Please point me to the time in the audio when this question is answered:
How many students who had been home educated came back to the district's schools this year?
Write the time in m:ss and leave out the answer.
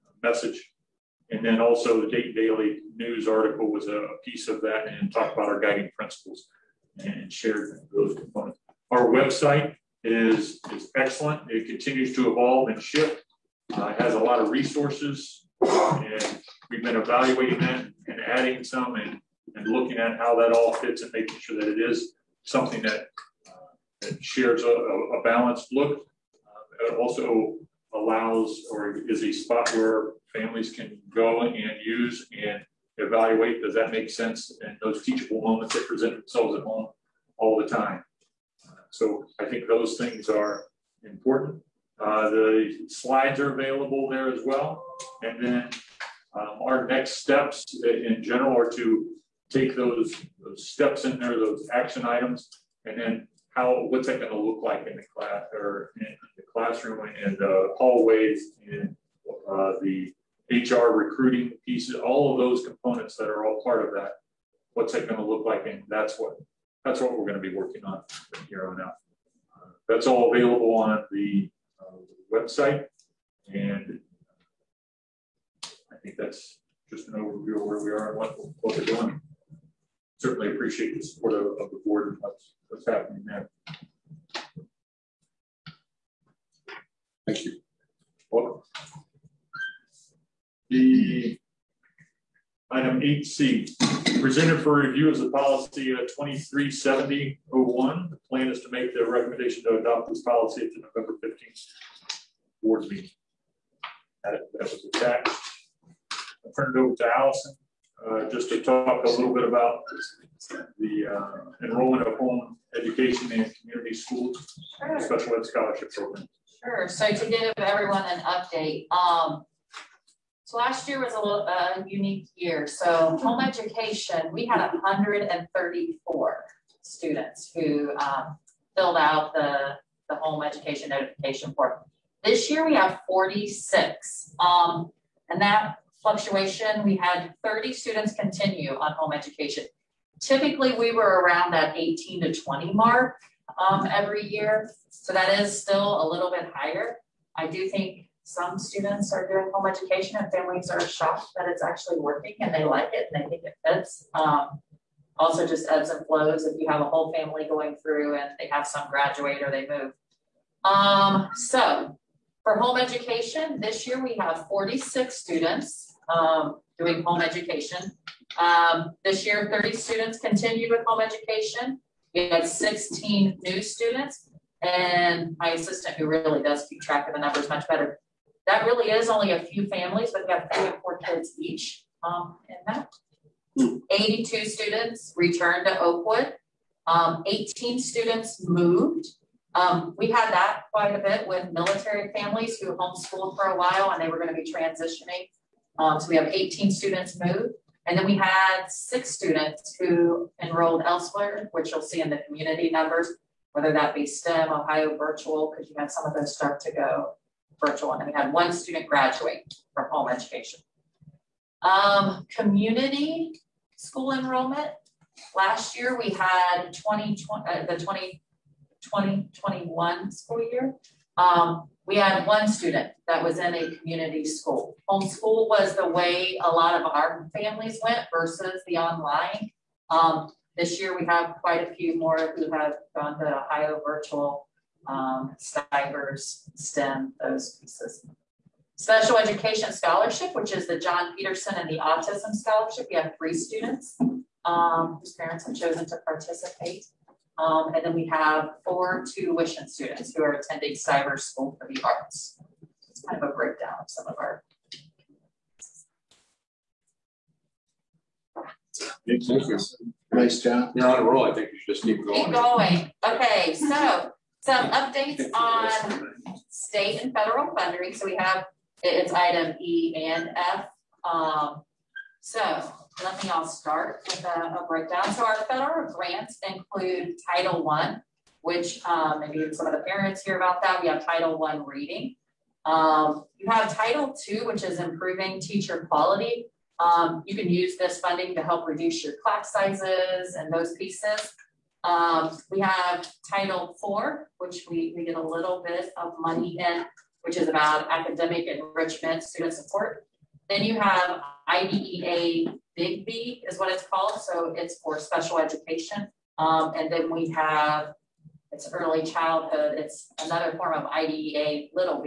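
3:03.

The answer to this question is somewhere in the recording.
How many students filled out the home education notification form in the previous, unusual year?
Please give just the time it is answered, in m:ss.
2:04.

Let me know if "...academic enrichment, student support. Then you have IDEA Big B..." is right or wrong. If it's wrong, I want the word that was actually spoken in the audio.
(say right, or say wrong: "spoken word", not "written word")
right.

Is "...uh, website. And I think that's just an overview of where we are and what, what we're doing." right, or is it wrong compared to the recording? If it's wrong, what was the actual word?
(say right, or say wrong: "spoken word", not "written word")
right.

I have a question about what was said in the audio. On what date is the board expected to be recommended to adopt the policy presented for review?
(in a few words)
November 15th.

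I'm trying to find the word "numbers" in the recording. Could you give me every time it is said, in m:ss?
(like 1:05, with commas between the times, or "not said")
2:57, 3:22.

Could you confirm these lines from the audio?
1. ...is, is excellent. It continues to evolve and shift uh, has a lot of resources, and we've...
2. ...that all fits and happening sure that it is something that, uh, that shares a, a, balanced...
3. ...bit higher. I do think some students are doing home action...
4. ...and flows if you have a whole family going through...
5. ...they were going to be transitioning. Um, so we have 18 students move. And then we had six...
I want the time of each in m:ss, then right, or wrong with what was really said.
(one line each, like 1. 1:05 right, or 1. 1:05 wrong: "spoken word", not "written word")
1. 0:10 right
2. 0:20 wrong: "making", not "happening"
3. 2:26 wrong: "education", not "action"
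4. 2:35 right
5. 3:14 right.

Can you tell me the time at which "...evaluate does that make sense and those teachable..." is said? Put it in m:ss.
0:32.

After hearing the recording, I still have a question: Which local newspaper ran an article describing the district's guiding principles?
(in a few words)
Dayton Daily News.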